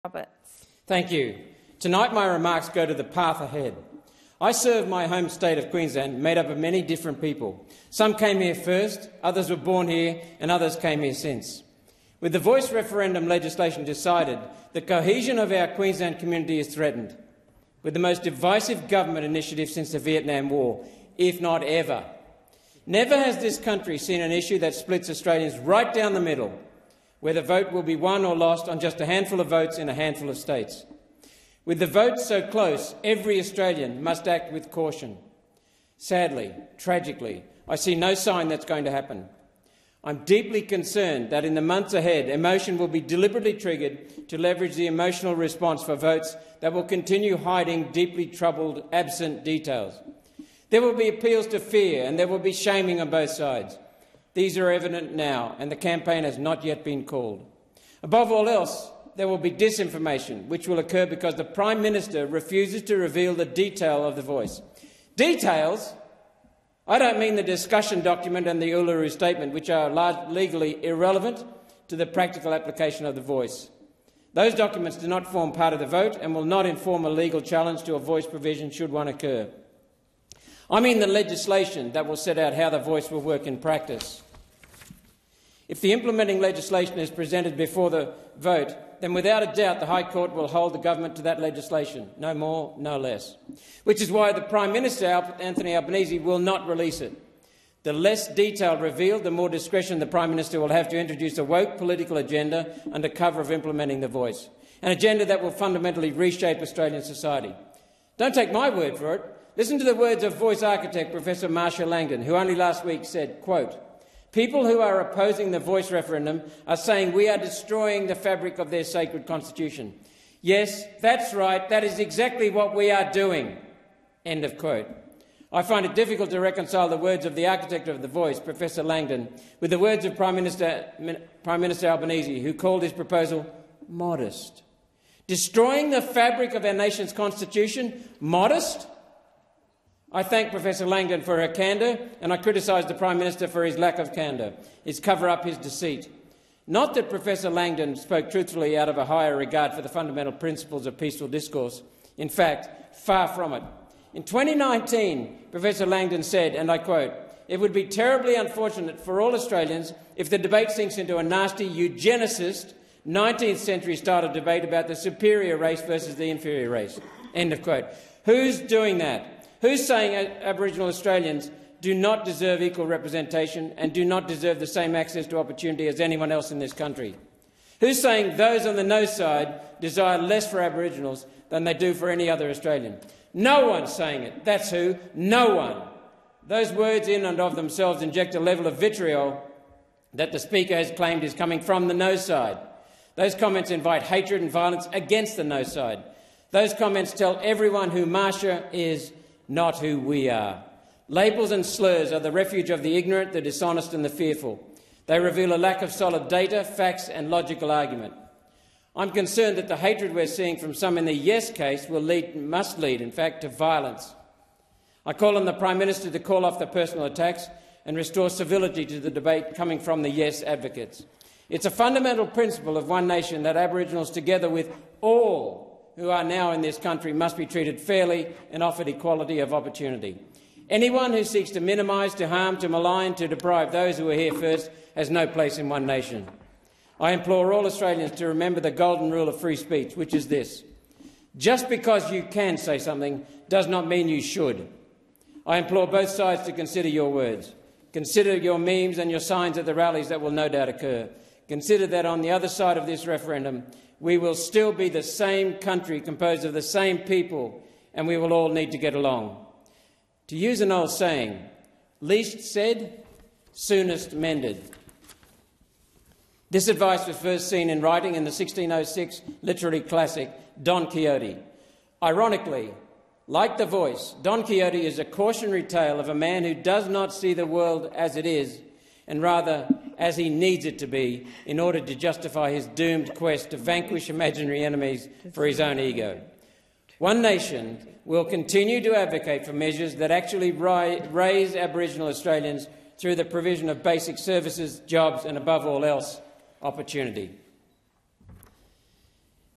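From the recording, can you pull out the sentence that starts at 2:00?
Yes, that's right, that is exactly what we are doing.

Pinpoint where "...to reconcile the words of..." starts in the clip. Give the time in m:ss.
2:06.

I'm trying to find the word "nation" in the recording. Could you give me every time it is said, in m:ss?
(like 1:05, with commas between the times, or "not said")
2:16, 3:43, 3:55, 4:47.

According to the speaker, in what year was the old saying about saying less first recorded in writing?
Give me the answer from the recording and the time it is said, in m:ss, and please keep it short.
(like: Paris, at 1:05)
1606, at 4:28.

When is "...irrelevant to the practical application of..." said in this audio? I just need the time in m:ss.
1:10.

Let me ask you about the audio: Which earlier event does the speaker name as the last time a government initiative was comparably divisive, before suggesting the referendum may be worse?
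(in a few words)
Vietnam War.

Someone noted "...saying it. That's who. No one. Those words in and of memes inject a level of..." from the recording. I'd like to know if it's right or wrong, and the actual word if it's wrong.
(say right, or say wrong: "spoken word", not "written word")
wrong: "themselves", not "memes".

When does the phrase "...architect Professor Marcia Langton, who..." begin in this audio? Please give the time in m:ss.
1:50.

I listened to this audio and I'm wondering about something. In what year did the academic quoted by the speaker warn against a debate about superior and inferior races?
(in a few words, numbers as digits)
2019.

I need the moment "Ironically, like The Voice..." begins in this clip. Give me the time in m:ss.
4:32.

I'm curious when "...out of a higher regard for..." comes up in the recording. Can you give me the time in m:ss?
2:28.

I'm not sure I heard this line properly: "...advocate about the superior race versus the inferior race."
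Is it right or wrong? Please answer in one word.
wrong.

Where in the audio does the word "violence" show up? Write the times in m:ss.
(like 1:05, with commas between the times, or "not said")
3:14, 3:33.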